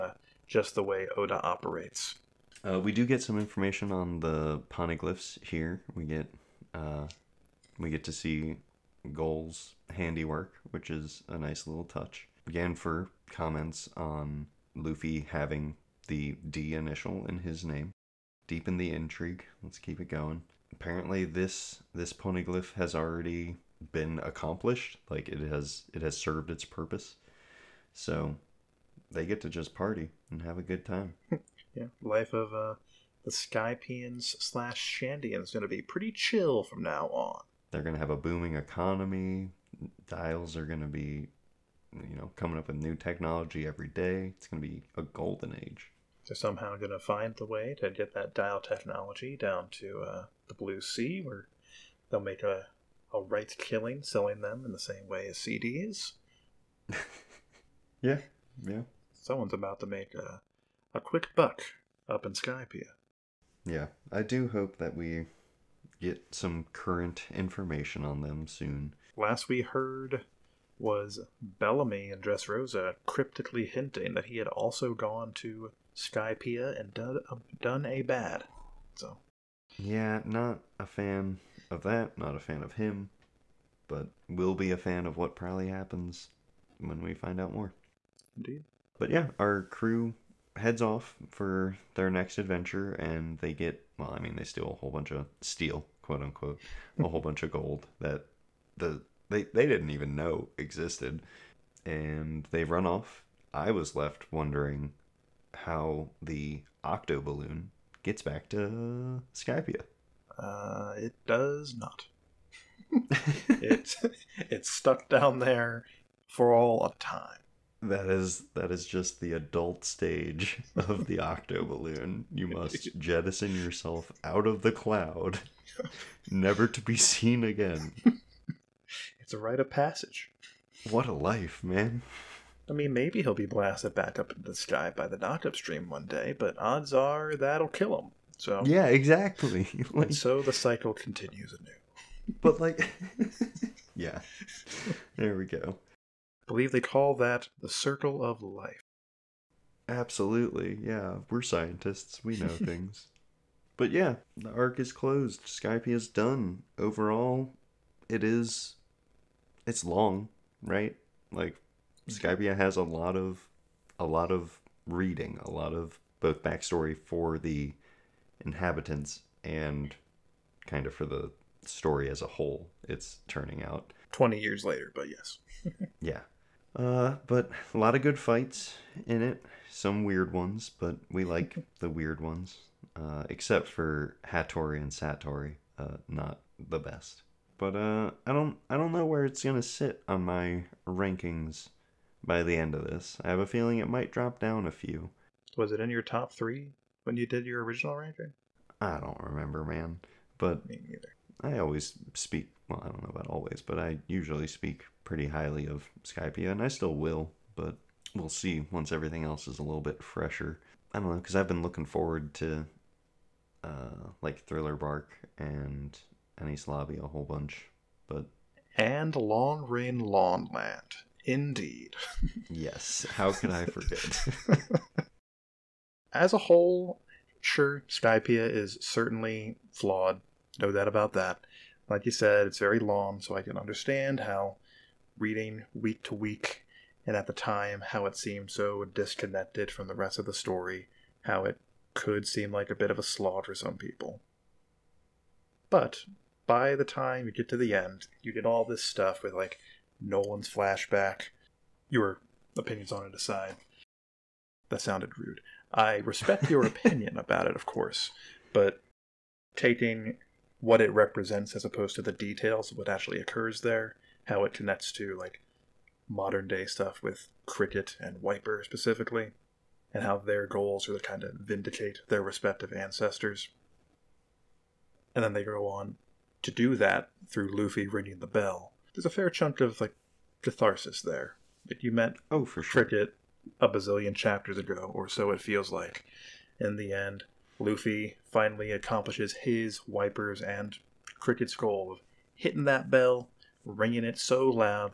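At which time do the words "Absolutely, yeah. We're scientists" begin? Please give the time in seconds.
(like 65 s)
149 s.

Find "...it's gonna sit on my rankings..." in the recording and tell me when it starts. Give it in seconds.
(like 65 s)
189 s.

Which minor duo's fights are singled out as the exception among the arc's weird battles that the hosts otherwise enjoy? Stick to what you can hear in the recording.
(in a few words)
Hattori and Satori.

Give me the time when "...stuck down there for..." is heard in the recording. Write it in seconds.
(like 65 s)
114 s.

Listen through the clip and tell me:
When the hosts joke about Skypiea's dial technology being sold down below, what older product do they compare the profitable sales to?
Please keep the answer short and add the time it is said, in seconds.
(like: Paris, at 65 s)
CDs, at 55 s.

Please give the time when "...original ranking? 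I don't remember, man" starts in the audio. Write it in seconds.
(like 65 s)
197 s.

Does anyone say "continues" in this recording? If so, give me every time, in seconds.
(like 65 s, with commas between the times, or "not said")
140 s.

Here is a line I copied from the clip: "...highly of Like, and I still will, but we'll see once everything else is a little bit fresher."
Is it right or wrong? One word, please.
wrong.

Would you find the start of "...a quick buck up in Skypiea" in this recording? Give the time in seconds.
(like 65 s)
60 s.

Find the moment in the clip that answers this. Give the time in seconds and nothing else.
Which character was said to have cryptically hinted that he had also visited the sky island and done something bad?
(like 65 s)
71 s.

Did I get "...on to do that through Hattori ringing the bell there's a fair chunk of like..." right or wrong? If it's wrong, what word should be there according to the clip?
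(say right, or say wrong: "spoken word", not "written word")
wrong: "Luffy", not "Hattori".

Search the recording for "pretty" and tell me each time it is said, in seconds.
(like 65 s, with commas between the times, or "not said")
35 s, 205 s.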